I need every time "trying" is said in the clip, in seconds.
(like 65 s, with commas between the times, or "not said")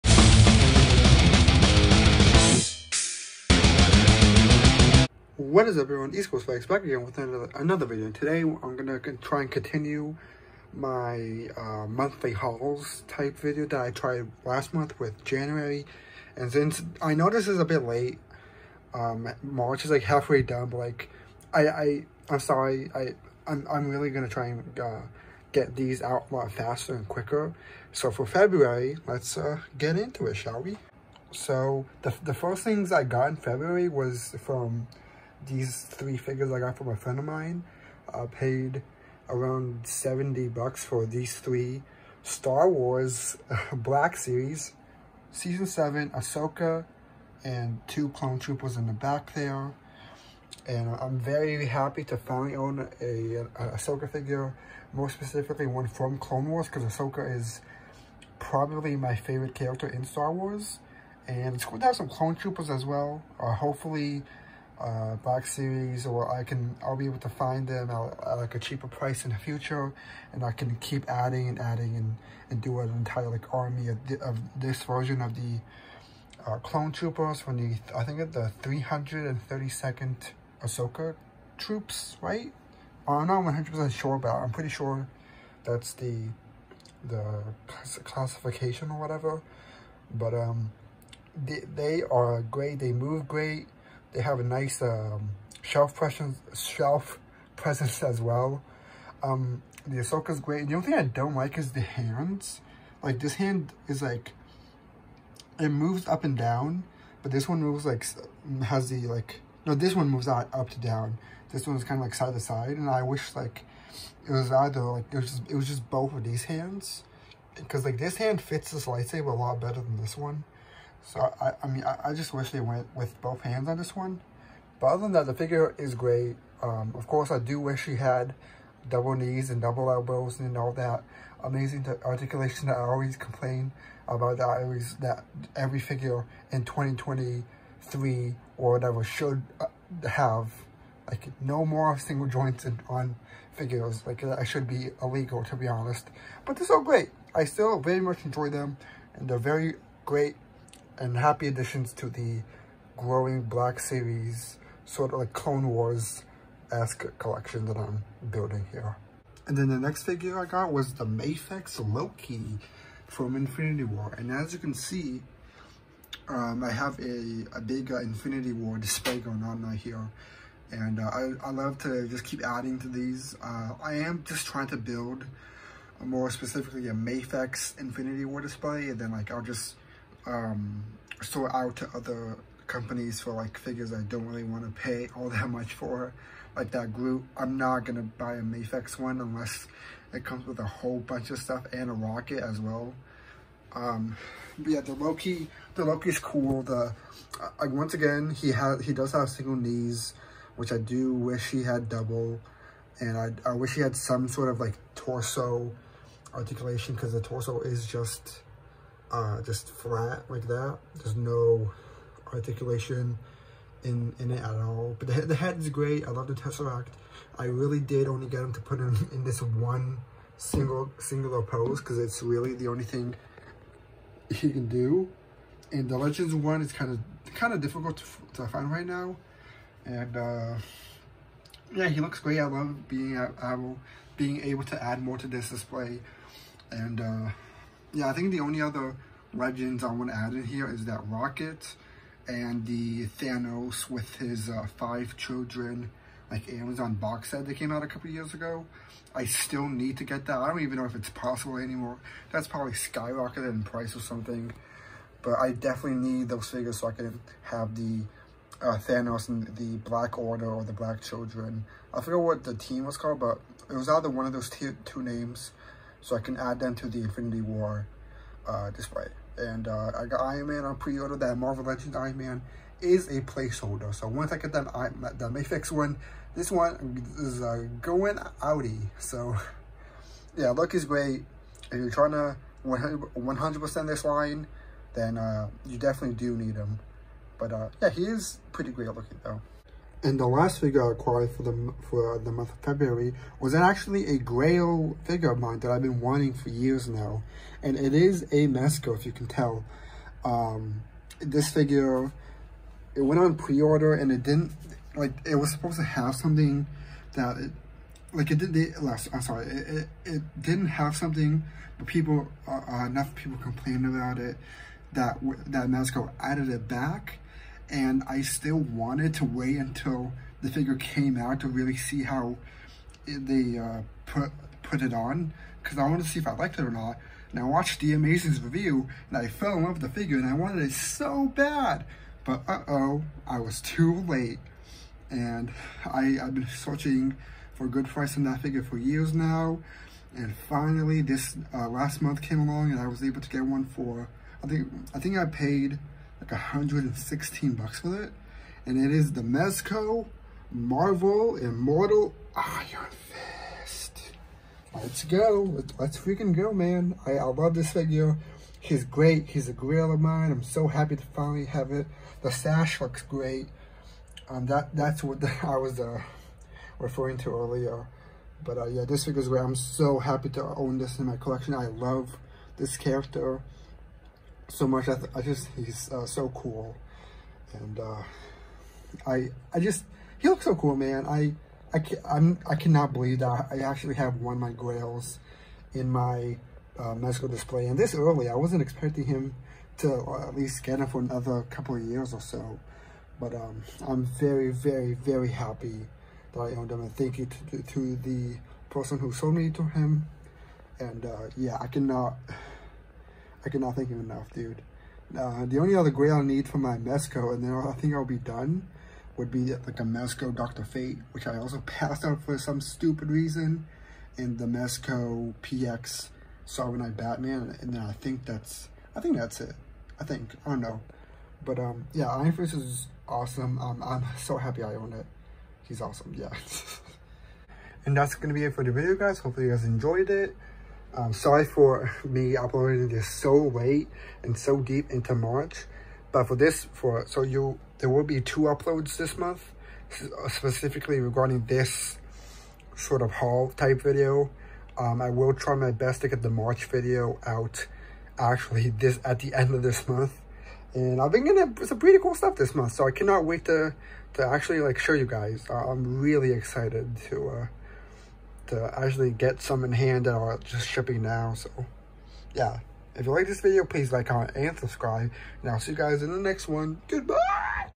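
174 s, 281 s.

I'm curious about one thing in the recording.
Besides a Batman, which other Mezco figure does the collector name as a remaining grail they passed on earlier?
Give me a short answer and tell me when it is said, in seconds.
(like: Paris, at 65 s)
Dr. Fate, at 410 s.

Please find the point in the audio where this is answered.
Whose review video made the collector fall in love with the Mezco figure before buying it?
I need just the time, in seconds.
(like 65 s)
327 s.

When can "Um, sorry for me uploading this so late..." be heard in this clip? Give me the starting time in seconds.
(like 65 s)
430 s.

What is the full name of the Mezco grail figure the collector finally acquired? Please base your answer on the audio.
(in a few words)
Immortal Iron Fist.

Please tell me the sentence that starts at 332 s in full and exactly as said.
But uh-oh, I was too late.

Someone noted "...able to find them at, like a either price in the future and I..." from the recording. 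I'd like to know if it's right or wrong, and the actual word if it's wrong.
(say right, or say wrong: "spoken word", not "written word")
wrong: "cheaper", not "either".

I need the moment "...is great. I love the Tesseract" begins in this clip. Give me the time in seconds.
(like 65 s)
215 s.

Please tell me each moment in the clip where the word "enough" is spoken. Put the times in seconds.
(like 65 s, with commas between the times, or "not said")
312 s, 404 s.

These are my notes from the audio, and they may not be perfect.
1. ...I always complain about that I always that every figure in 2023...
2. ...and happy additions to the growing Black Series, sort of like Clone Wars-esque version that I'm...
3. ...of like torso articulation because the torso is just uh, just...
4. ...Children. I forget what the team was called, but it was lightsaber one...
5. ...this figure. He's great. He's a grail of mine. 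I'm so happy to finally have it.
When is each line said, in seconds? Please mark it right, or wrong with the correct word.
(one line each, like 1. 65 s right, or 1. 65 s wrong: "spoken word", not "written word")
1. 132 s right
2. 150 s wrong: "collection", not "version"
3. 204 s right
4. 261 s wrong: "either", not "lightsaber"
5. 357 s right.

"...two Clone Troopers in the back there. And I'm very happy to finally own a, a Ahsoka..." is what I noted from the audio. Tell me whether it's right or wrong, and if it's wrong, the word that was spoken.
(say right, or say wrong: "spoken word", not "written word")
right.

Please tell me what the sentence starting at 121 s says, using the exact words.
So I, I mean, I, I, just wish they went with both hands on this one.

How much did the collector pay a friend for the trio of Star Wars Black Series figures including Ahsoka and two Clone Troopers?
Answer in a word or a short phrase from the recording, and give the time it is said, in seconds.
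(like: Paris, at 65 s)
$70, at 39 s.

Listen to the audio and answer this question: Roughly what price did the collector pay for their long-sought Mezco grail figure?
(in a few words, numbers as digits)
$116.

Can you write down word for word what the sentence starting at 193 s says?
Um, but yeah, the Loki, the Loki's cool.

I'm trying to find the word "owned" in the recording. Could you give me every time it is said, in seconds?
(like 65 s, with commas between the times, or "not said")
396 s.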